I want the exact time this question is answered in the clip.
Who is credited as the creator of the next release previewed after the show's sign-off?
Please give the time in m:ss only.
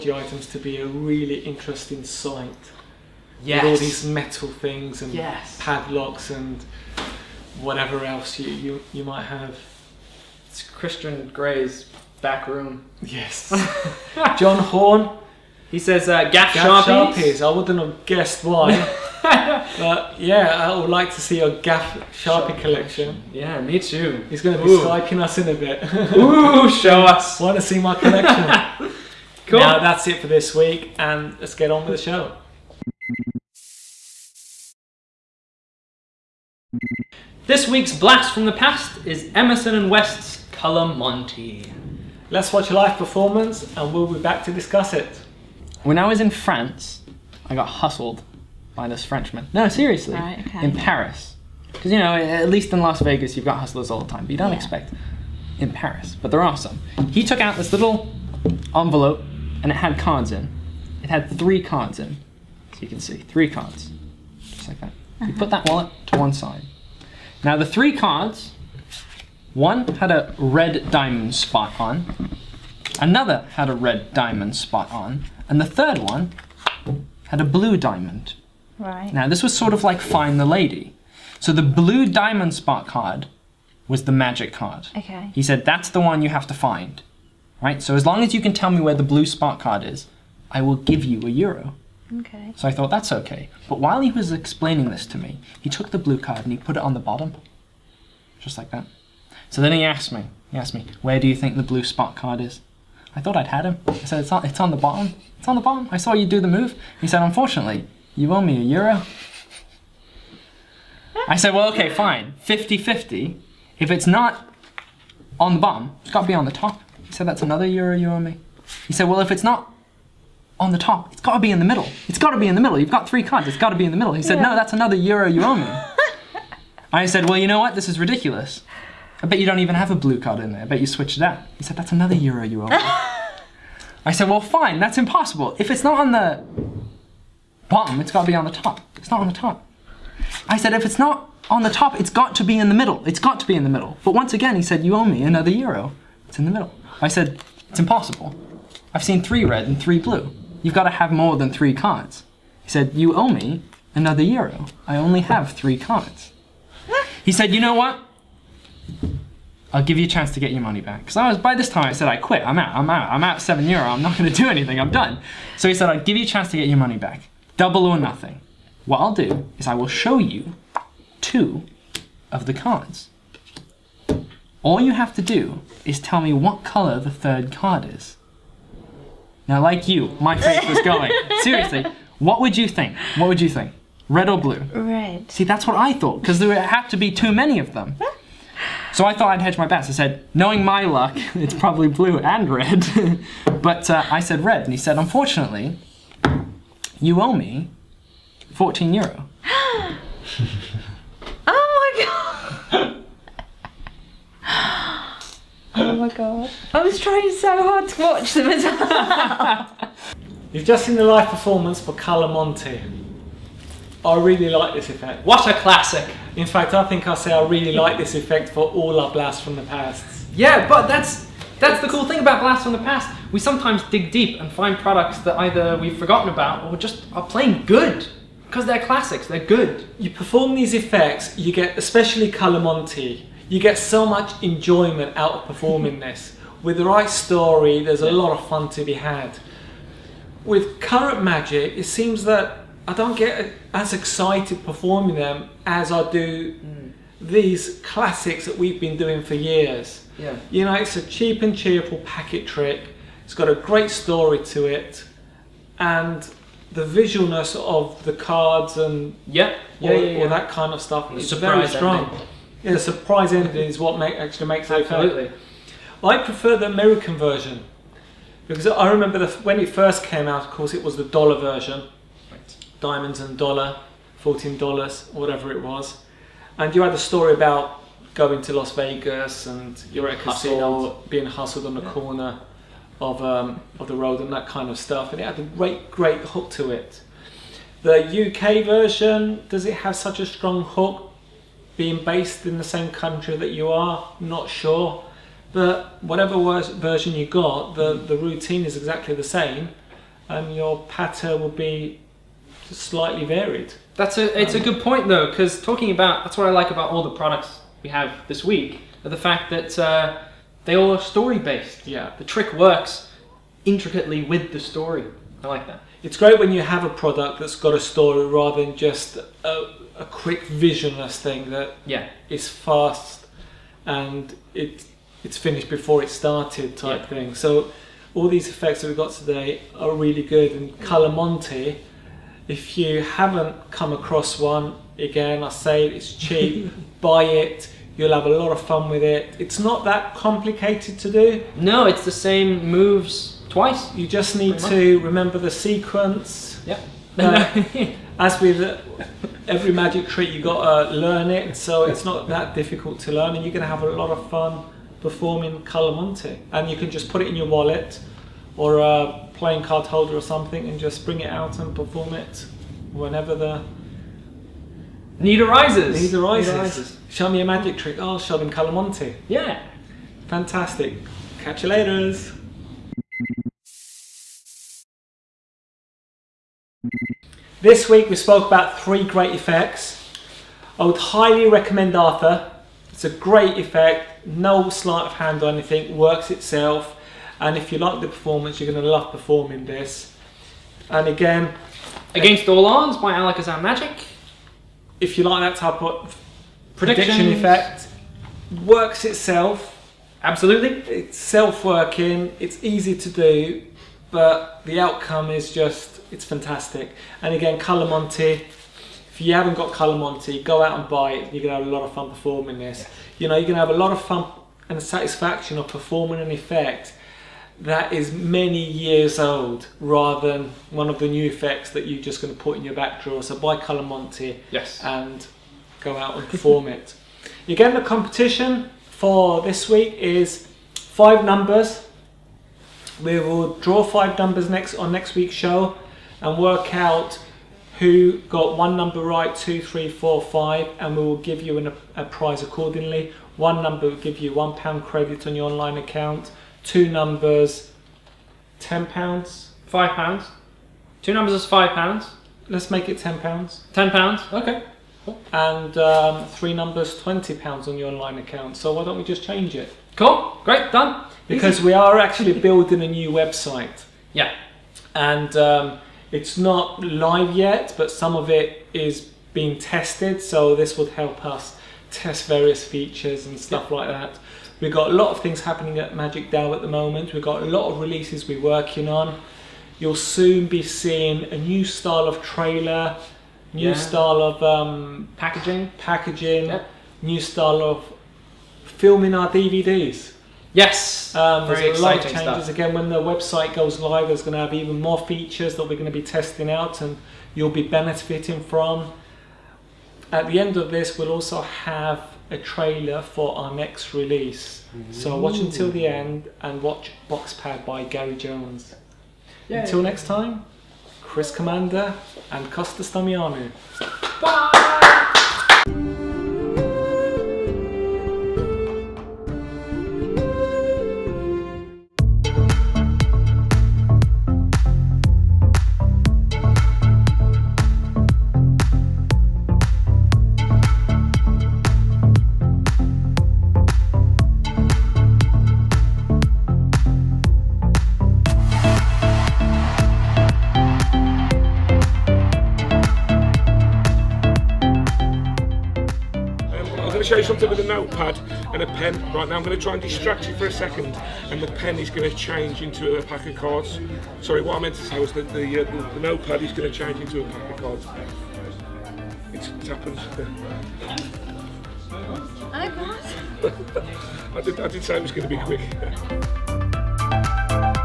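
8:27.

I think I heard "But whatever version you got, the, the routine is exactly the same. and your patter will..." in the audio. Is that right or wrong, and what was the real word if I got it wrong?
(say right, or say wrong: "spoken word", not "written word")
right.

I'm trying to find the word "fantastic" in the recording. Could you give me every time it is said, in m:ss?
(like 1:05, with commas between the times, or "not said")
6:10, 6:46.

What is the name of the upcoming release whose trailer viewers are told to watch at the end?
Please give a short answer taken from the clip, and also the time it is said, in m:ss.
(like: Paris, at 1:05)
Boxpad, at 8:27.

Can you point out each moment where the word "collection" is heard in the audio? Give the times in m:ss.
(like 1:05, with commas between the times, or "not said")
0:22, 0:27.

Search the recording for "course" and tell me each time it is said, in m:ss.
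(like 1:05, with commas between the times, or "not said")
4:30.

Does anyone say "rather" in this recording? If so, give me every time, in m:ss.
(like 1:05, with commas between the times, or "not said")
5:18, 6:59.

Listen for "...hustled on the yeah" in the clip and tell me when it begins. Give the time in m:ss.
4:41.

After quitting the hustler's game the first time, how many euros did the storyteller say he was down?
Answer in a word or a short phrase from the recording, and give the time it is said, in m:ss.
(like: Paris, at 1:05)
7 euros, at 2:43.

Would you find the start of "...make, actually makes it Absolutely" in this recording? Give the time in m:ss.
4:23.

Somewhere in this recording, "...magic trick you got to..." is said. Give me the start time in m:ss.
5:49.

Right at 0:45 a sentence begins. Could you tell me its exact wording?
When I was in France, I got hustled by this Frenchman.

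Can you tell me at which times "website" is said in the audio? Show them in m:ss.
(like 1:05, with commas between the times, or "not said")
7:43, 8:12.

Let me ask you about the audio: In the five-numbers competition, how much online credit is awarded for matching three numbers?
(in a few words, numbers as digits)
£20.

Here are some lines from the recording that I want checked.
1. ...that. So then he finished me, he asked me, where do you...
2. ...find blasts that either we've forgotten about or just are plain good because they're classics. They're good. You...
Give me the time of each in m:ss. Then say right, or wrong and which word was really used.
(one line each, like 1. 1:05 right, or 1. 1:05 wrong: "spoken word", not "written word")
1. 1:38 wrong: "asked", not "finished"
2. 3:44 wrong: "products", not "blasts".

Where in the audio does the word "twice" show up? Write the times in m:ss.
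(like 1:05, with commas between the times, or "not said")
5:43.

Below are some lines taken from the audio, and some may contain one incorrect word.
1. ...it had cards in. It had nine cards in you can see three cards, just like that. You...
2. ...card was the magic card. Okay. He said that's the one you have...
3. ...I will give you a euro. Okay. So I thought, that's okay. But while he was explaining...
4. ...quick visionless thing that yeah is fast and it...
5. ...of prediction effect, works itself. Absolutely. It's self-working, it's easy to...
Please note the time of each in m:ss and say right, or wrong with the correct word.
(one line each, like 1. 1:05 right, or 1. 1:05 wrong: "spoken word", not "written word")
1. 0:59 wrong: "three", not "nine"
2. 1:22 right
3. 1:30 right
4. 5:20 right
5. 6:35 right.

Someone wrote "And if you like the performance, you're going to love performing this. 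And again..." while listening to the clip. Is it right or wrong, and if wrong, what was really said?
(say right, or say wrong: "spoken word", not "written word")
right.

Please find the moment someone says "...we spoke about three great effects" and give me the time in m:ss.
6:18.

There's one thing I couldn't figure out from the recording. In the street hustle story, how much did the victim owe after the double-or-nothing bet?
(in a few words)
14 euros.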